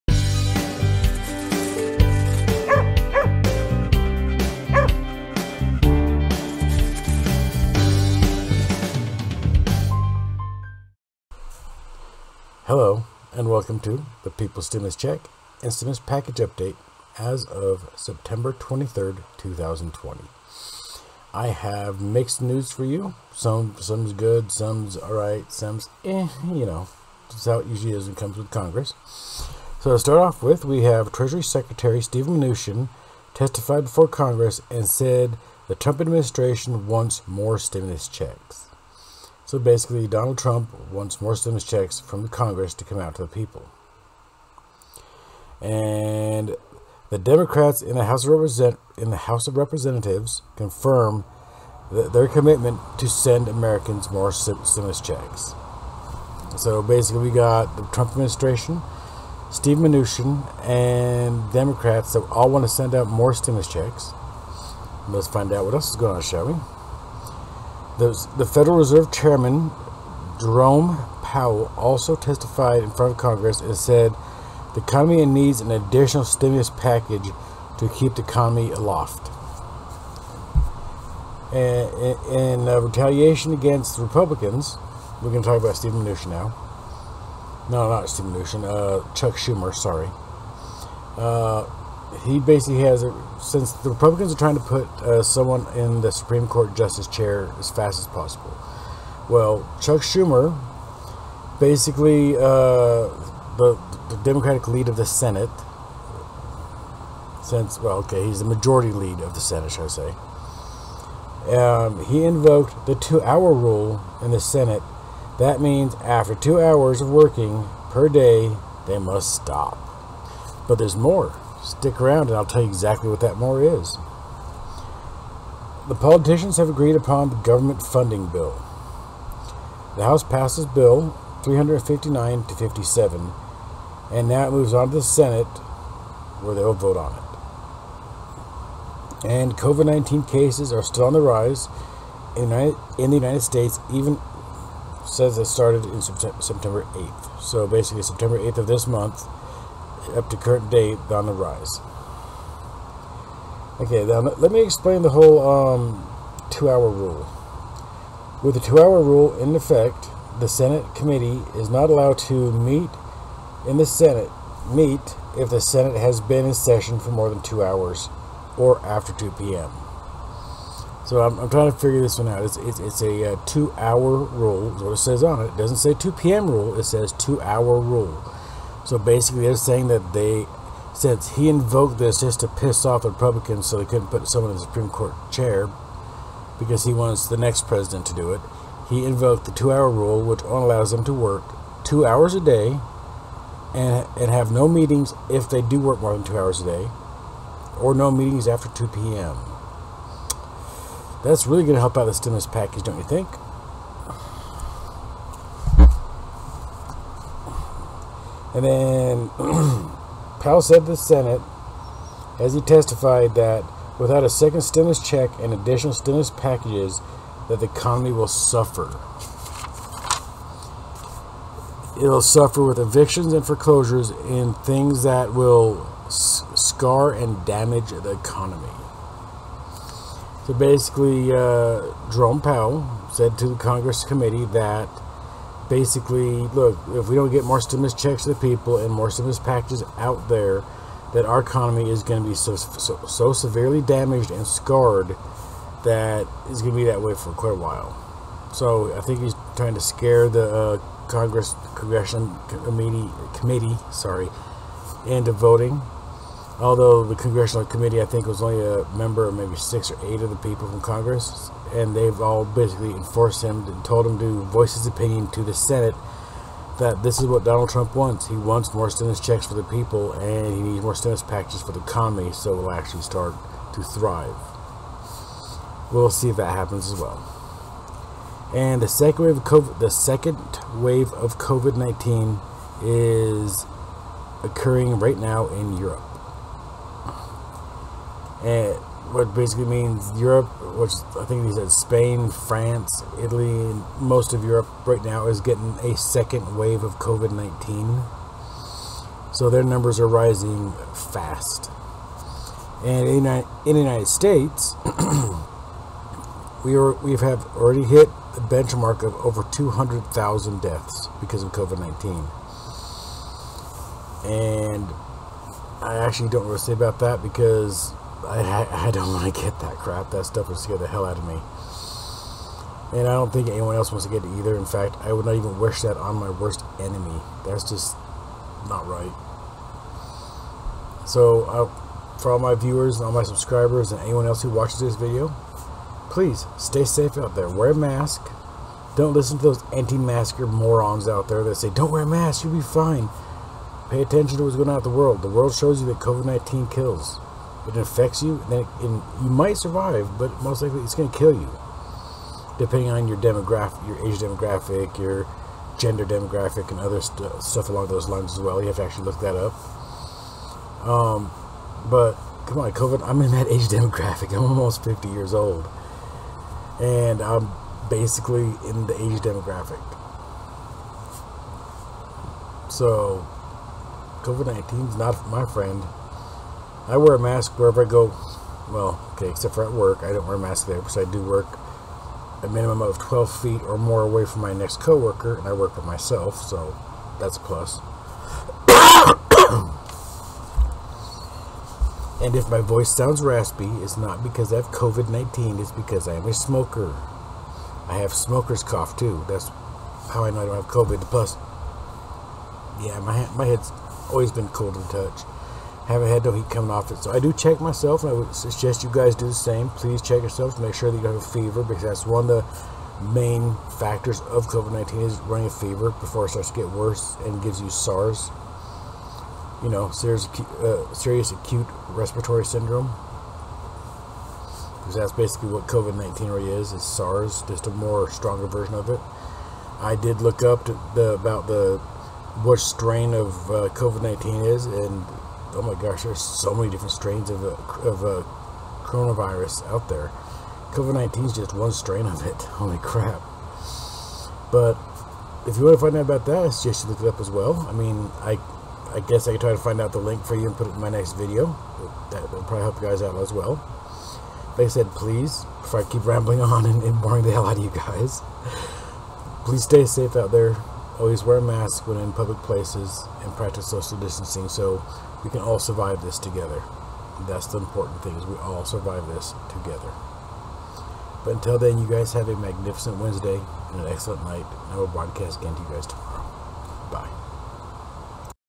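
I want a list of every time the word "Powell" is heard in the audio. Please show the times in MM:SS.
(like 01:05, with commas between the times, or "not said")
01:11, 03:30, 03:52.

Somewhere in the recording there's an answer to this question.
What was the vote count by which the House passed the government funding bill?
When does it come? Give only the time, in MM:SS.
02:11.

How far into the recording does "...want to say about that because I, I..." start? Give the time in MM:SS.
05:16.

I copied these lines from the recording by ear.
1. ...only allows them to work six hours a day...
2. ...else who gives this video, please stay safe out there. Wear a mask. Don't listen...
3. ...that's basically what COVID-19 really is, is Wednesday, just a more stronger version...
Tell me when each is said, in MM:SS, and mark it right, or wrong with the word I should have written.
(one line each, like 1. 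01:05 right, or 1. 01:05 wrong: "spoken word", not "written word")
1. 03:10 wrong: "two", not "six"
2. 05:34 wrong: "watches", not "gives"
3. 07:04 wrong: "SARS", not "Wednesday".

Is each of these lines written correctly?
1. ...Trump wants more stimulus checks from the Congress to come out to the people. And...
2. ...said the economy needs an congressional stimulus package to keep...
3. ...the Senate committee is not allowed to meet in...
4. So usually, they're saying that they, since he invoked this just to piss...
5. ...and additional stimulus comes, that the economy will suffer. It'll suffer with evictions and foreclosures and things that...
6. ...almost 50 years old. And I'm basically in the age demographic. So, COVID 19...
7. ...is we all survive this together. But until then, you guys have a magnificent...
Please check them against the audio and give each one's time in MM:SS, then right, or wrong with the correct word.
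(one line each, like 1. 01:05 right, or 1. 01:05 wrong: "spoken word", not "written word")
1. 00:40 right
2. 01:13 wrong: "additional", not "congressional"
3. 02:40 right
4. 02:58 wrong: "basically", not "usually"
5. 03:35 wrong: "packages", not "comes"
6. 06:04 right
7. 07:48 right.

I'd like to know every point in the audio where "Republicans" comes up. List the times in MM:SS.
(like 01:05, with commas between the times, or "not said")
01:24, 01:33, 03:03.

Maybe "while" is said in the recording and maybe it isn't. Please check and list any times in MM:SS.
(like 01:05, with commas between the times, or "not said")
04:07.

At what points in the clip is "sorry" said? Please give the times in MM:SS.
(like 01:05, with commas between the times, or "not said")
01:29, 04:13.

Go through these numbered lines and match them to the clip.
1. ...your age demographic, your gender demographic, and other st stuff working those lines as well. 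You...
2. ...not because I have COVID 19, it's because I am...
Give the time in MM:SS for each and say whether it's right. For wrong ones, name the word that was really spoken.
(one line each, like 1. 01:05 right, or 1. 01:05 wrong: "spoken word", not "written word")
1. 05:53 wrong: "along", not "working"
2. 06:33 right.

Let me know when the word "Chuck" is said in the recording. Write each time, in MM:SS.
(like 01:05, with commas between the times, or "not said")
01:29, 01:39.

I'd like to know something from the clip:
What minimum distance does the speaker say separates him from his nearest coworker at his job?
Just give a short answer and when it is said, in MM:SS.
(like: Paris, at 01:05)
12 feet, at 06:22.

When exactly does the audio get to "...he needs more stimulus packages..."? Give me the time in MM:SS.
04:30.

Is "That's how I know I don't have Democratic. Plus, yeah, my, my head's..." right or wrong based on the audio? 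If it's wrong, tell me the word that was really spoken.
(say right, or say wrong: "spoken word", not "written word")
wrong: "COVID", not "Democratic".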